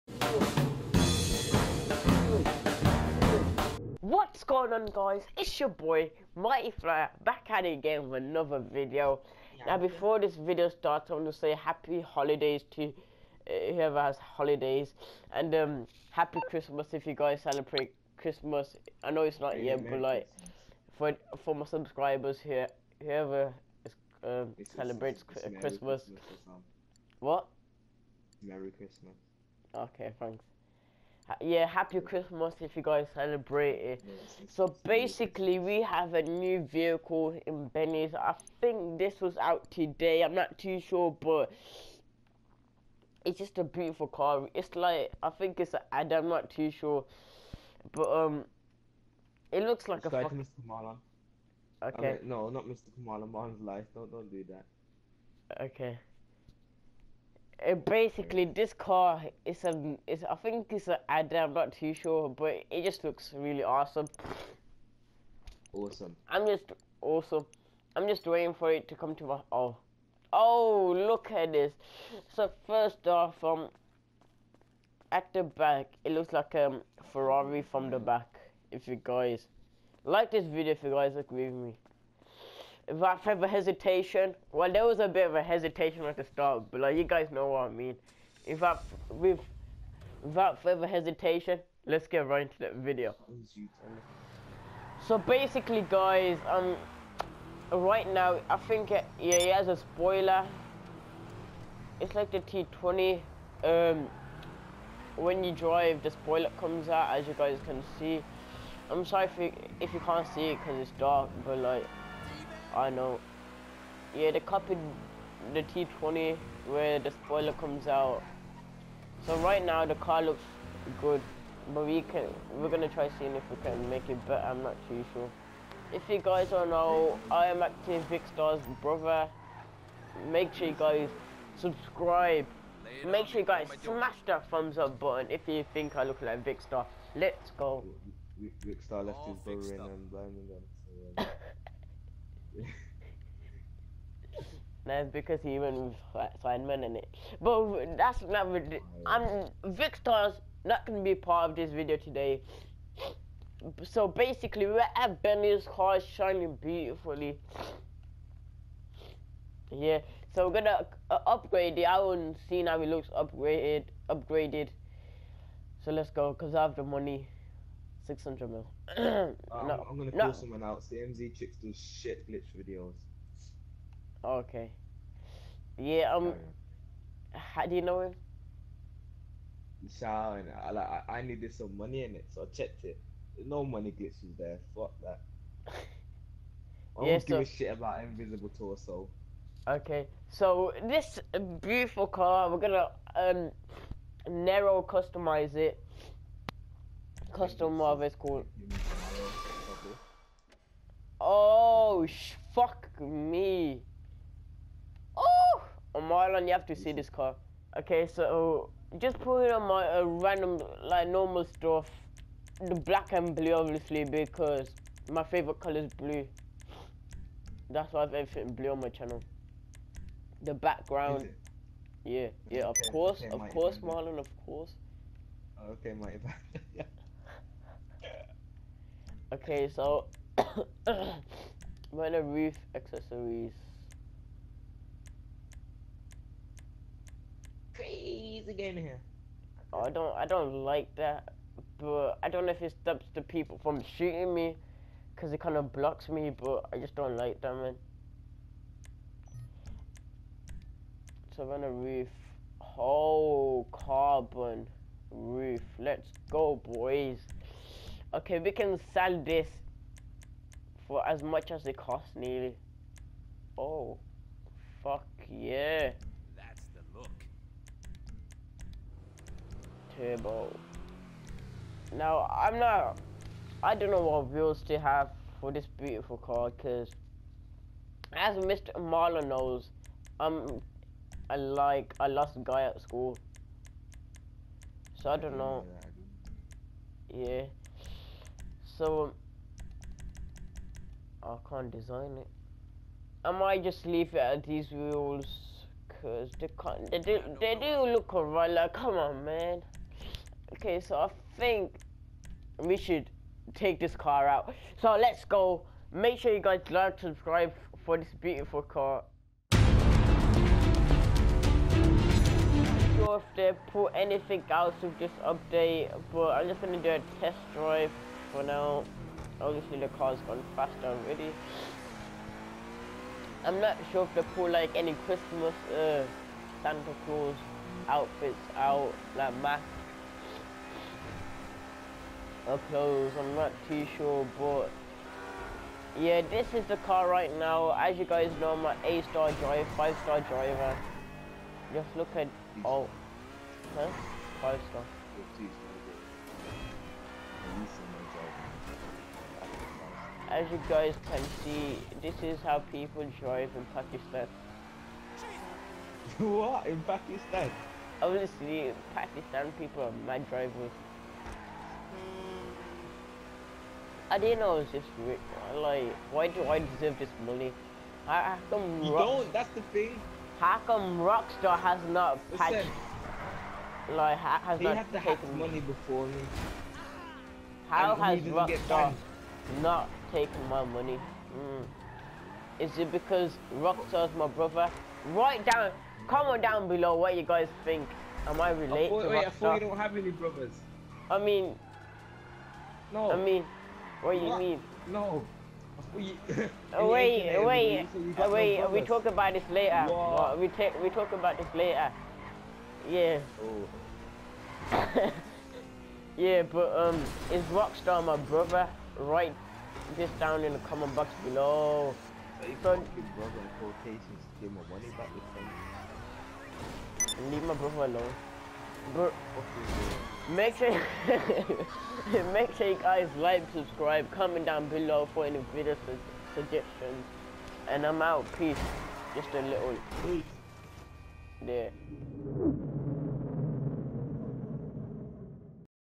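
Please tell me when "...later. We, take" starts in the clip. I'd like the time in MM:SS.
06:39.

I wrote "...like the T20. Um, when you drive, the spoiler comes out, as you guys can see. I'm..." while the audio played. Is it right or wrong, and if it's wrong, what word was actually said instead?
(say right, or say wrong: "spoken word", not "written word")
right.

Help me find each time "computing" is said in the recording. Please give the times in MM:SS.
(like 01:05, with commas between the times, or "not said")
not said.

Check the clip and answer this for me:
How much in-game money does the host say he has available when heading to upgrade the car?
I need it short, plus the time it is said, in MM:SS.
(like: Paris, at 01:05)
600 mil, at 02:48.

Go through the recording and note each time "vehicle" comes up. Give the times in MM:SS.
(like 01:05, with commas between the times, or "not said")
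00:36.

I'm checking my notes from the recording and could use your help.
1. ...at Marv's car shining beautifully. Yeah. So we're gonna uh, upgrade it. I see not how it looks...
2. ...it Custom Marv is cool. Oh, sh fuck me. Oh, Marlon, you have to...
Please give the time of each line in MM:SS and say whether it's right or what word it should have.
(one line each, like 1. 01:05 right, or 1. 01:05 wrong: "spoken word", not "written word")
1. 02:34 wrong: "Benny", not "Marv"
2. 03:15 right.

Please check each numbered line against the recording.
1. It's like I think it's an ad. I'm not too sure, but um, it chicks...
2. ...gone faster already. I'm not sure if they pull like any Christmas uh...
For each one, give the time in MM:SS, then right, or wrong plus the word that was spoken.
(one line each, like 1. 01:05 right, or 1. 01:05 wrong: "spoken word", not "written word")
1. 00:44 wrong: "looks", not "chicks"
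2. 05:20 right.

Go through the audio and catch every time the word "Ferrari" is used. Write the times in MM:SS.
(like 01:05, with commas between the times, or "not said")
01:17.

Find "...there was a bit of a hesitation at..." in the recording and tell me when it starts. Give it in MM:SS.
01:24.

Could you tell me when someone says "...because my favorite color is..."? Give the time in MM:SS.
03:34.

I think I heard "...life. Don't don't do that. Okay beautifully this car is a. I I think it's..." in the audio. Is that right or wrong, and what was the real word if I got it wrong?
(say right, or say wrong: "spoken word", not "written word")
wrong: "basically", not "beautifully".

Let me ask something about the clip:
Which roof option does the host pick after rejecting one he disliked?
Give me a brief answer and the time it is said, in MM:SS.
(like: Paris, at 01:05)
Carbon roof, at 04:12.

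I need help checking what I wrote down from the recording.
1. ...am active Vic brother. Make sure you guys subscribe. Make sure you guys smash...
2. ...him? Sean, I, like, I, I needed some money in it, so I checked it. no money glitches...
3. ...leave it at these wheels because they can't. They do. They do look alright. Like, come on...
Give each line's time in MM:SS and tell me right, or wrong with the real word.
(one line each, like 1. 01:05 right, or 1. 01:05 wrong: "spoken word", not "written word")
1. 02:07 right
2. 02:58 right
3. 04:53 right.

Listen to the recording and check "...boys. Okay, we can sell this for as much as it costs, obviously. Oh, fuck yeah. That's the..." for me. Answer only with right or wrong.
wrong.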